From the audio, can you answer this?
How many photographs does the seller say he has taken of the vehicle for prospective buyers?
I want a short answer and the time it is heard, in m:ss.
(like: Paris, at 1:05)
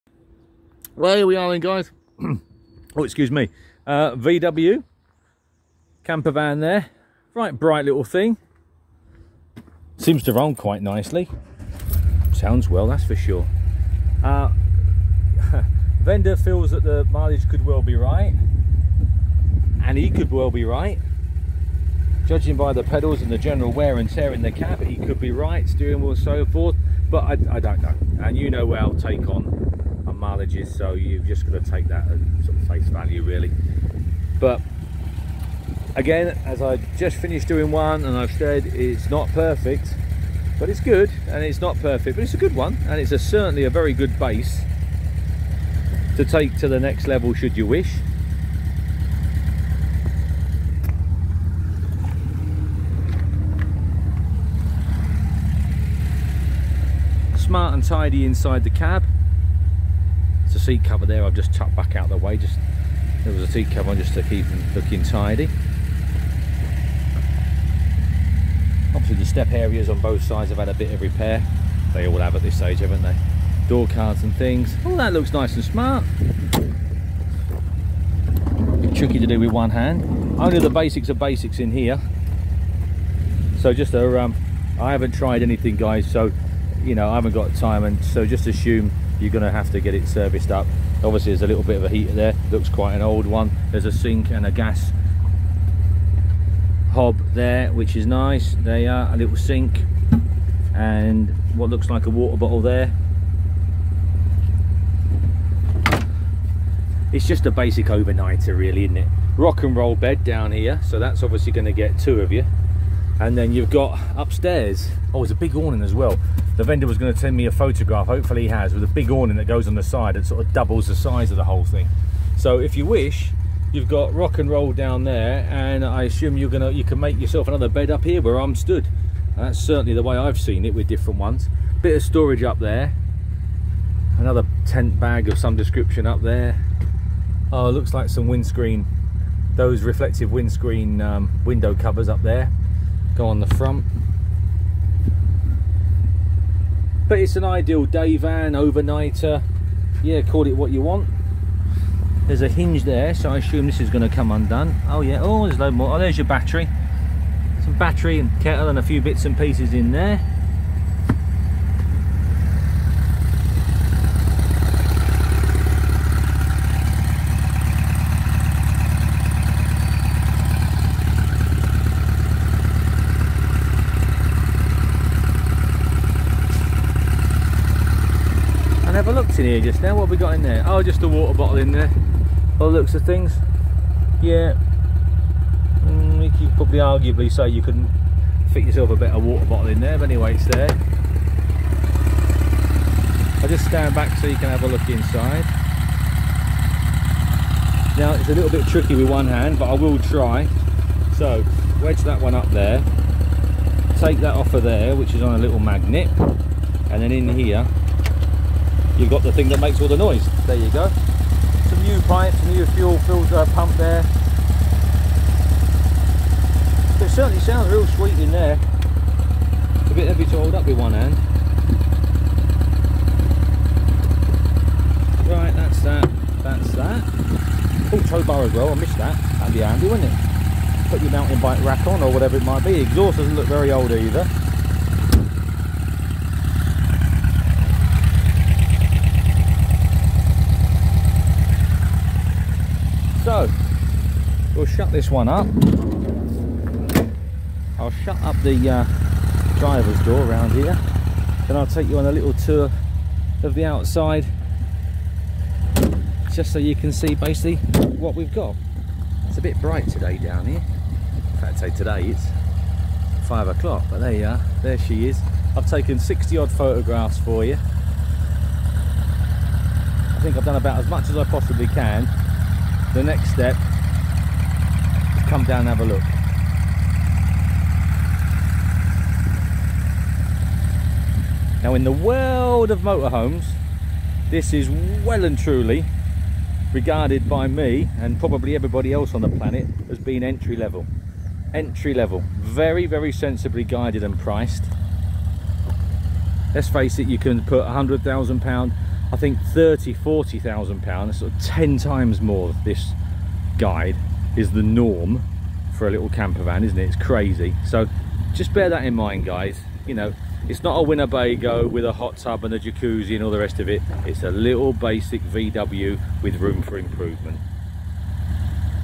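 60, at 4:25.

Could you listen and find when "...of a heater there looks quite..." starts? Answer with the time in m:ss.
1:31.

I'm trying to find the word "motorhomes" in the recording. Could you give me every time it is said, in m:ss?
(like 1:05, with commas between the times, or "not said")
4:42.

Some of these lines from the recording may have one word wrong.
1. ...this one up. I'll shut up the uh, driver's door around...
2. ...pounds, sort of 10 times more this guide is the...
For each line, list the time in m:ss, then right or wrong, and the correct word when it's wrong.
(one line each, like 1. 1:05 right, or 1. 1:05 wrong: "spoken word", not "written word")
1. 4:04 right
2. 5:00 right.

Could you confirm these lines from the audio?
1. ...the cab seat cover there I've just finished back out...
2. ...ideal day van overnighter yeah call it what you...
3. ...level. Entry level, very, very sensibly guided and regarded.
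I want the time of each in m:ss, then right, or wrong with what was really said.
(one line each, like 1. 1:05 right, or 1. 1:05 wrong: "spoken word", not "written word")
1. 0:58 wrong: "tucked", not "finished"
2. 2:27 right
3. 4:50 wrong: "priced", not "regarded".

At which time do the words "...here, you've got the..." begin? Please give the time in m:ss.
3:27.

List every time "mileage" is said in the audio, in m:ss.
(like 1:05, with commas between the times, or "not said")
0:17, 0:30.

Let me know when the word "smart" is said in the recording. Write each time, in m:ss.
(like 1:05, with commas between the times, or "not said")
0:57, 1:15.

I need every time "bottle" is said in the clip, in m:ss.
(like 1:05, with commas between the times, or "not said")
1:42, 3:01, 3:09.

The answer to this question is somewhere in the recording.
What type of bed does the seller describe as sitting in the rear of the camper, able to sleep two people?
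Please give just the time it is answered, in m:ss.
1:49.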